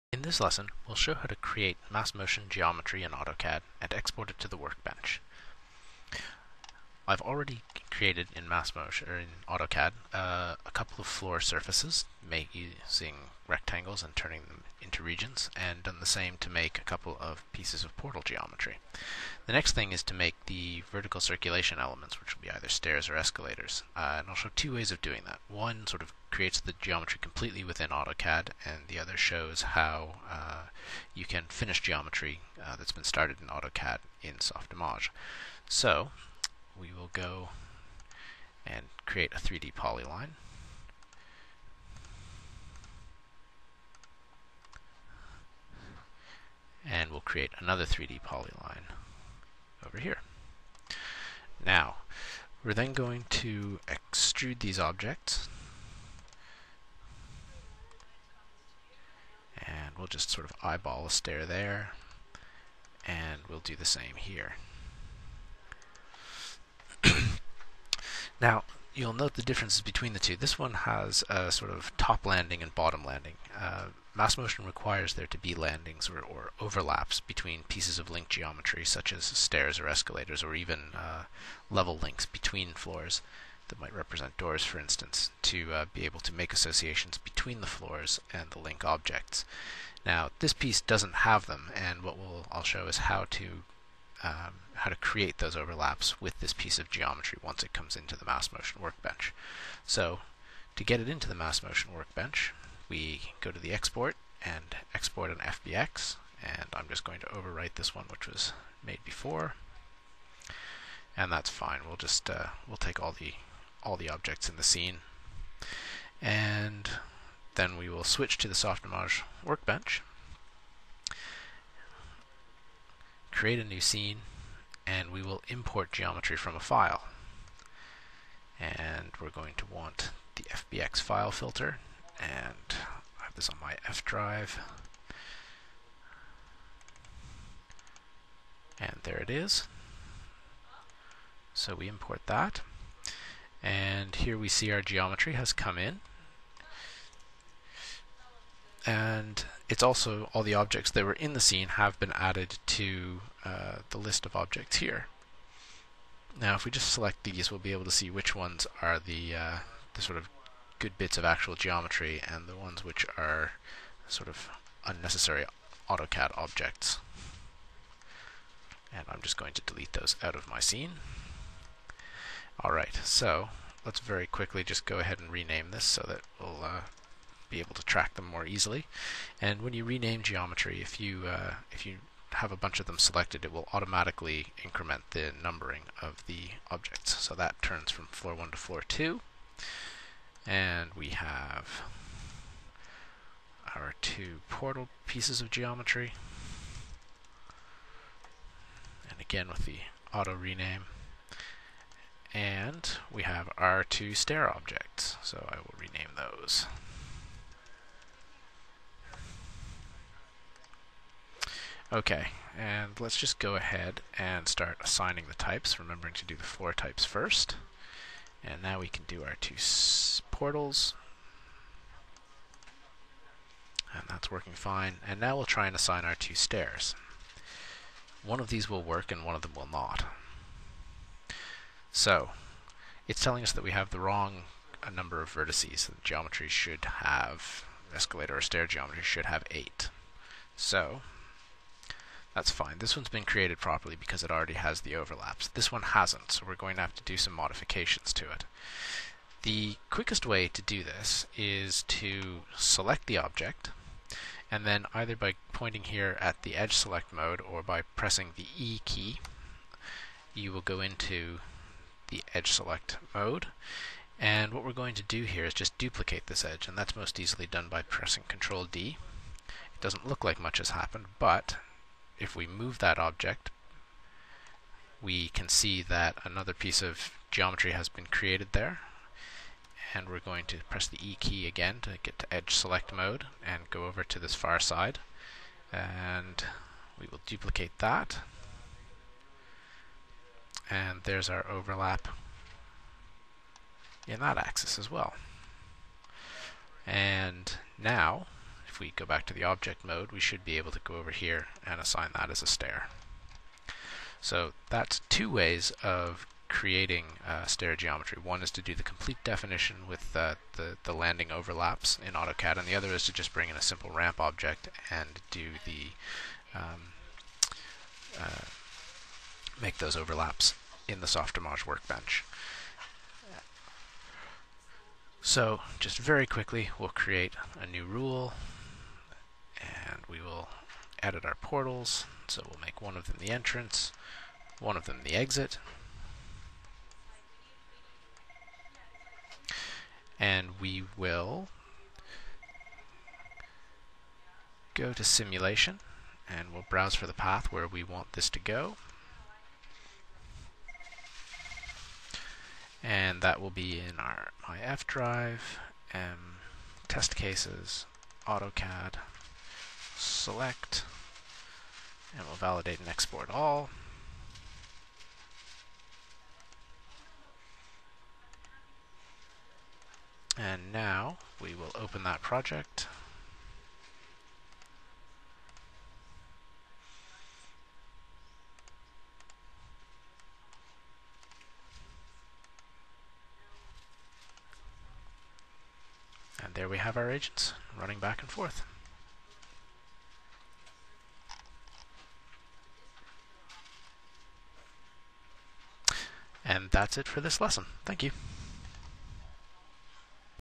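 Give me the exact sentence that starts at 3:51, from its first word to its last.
So, it's telling us that we have the wrong uh, number of vertices.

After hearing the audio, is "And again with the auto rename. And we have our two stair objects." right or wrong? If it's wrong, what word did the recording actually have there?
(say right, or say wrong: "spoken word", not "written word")
right.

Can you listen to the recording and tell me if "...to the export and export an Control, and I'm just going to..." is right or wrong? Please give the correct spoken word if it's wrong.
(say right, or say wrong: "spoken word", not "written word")
wrong: "FBX", not "Control".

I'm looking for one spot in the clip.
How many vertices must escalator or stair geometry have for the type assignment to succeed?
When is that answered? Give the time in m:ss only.
3:59.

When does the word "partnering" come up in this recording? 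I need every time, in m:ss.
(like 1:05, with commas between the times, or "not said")
not said.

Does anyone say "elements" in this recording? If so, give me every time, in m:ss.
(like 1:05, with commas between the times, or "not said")
0:21.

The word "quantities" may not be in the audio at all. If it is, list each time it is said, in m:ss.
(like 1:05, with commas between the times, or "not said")
not said.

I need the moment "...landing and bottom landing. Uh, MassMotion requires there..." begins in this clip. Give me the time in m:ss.
1:12.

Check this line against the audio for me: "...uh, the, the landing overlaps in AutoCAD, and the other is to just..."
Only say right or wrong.
right.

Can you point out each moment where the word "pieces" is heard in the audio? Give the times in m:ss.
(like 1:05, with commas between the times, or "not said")
0:17, 1:17, 1:30, 1:36, 3:15, 4:36.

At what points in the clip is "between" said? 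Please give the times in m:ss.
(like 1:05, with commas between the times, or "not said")
1:09, 1:17, 1:22, 1:27.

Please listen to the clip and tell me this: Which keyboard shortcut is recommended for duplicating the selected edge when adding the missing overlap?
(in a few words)
Control D.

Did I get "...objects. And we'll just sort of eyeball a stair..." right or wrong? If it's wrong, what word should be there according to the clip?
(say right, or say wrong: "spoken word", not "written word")
right.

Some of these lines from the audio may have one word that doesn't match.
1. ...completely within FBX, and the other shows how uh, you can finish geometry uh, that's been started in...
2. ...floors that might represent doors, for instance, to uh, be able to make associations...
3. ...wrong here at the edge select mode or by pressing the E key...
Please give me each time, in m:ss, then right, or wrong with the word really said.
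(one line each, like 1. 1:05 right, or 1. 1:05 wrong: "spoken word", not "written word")
1. 0:27 wrong: "AutoCAD", not "FBX"
2. 1:22 right
3. 4:15 wrong: "pointing", not "wrong".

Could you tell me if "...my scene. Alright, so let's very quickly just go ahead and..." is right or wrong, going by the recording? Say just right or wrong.
right.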